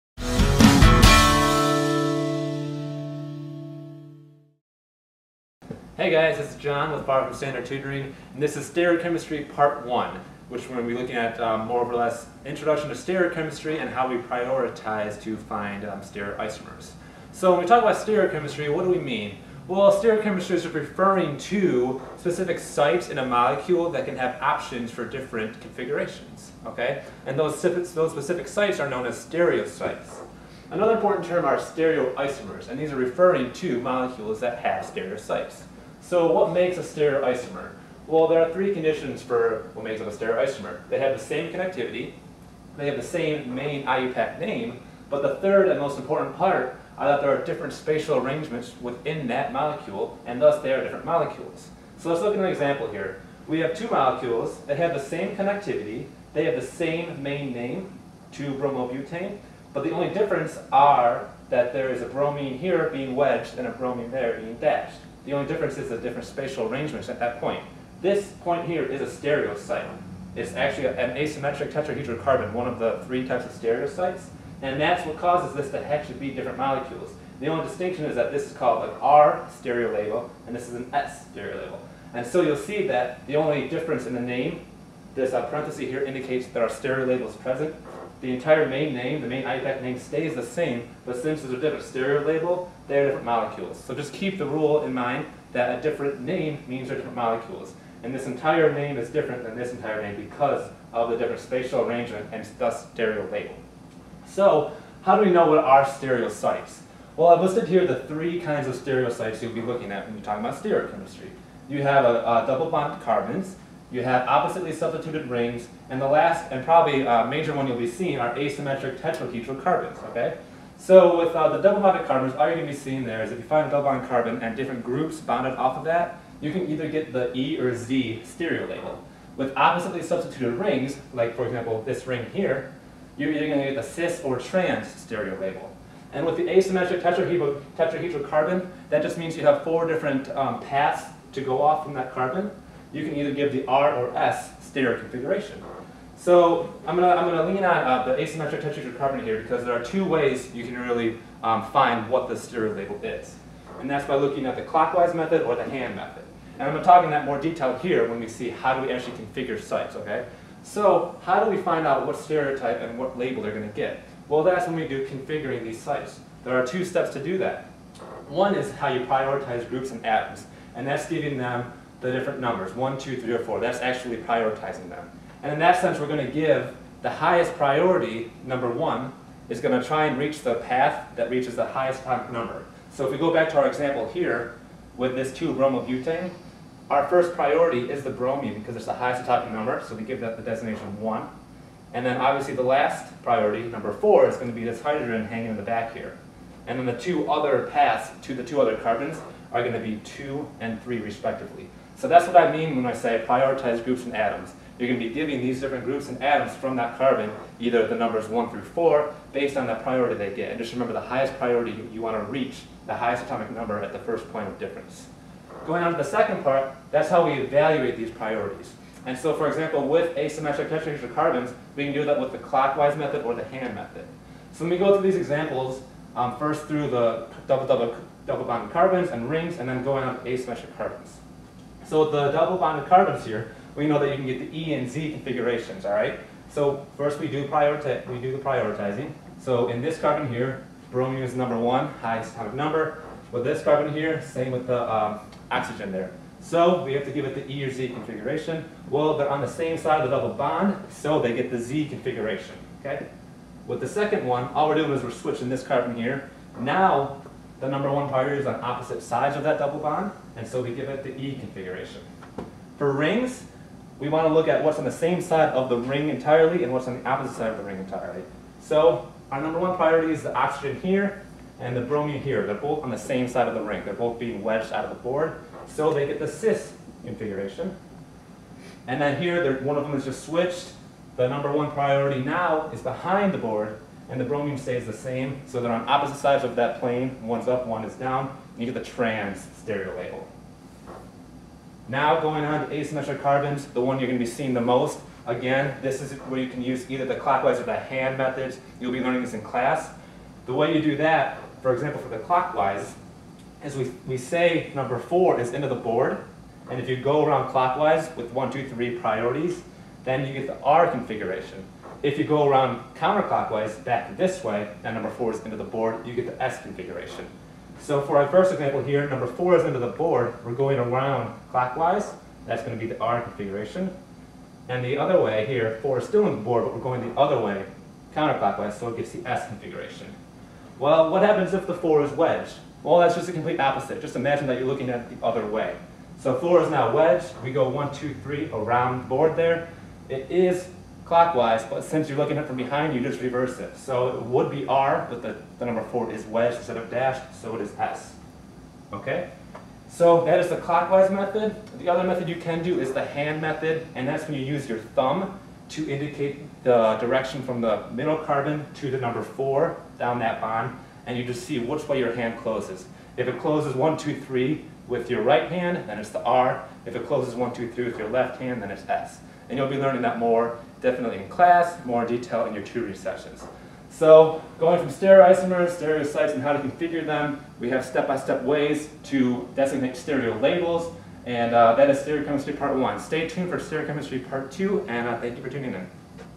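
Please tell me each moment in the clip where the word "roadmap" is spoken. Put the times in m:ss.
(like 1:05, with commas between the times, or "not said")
not said.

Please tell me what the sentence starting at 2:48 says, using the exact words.
One is how you prioritize groups and atoms, and that's giving them the different numbers, one, two, three, or four.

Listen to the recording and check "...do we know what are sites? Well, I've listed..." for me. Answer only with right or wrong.
right.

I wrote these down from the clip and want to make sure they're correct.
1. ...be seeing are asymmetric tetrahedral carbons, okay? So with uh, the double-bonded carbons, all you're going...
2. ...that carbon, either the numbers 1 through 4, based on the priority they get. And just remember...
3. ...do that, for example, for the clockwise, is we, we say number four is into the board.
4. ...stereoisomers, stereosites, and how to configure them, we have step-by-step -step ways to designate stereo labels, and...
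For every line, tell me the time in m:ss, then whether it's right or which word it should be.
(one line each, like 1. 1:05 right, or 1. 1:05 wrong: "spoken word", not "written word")
1. 1:57 right
2. 3:26 right
3. 5:00 right
4. 6:14 right.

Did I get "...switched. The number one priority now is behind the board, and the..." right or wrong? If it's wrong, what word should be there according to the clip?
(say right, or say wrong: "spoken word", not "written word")
right.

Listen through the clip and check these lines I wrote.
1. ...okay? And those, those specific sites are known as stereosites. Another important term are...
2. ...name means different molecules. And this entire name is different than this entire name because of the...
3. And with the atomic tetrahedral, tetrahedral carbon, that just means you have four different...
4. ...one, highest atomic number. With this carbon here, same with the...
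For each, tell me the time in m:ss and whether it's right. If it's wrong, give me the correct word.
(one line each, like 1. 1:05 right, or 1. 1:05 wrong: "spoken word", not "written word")
1. 0:26 right
2. 1:36 right
3. 2:16 wrong: "asymmetric", not "atomic"
4. 4:01 right.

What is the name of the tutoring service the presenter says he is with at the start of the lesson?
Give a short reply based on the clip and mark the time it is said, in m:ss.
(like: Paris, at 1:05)
Far from Standard Tutoring, at 0:07.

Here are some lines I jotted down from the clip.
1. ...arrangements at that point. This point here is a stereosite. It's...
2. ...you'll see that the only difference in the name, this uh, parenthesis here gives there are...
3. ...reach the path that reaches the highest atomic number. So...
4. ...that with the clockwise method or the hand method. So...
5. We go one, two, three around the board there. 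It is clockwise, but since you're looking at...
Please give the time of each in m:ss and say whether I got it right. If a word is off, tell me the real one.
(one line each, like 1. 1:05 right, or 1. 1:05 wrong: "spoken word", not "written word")
1. 1:06 right
2. 1:22 wrong: "indicates", not "gives"
3. 3:00 right
4. 3:42 right
5. 5:37 right.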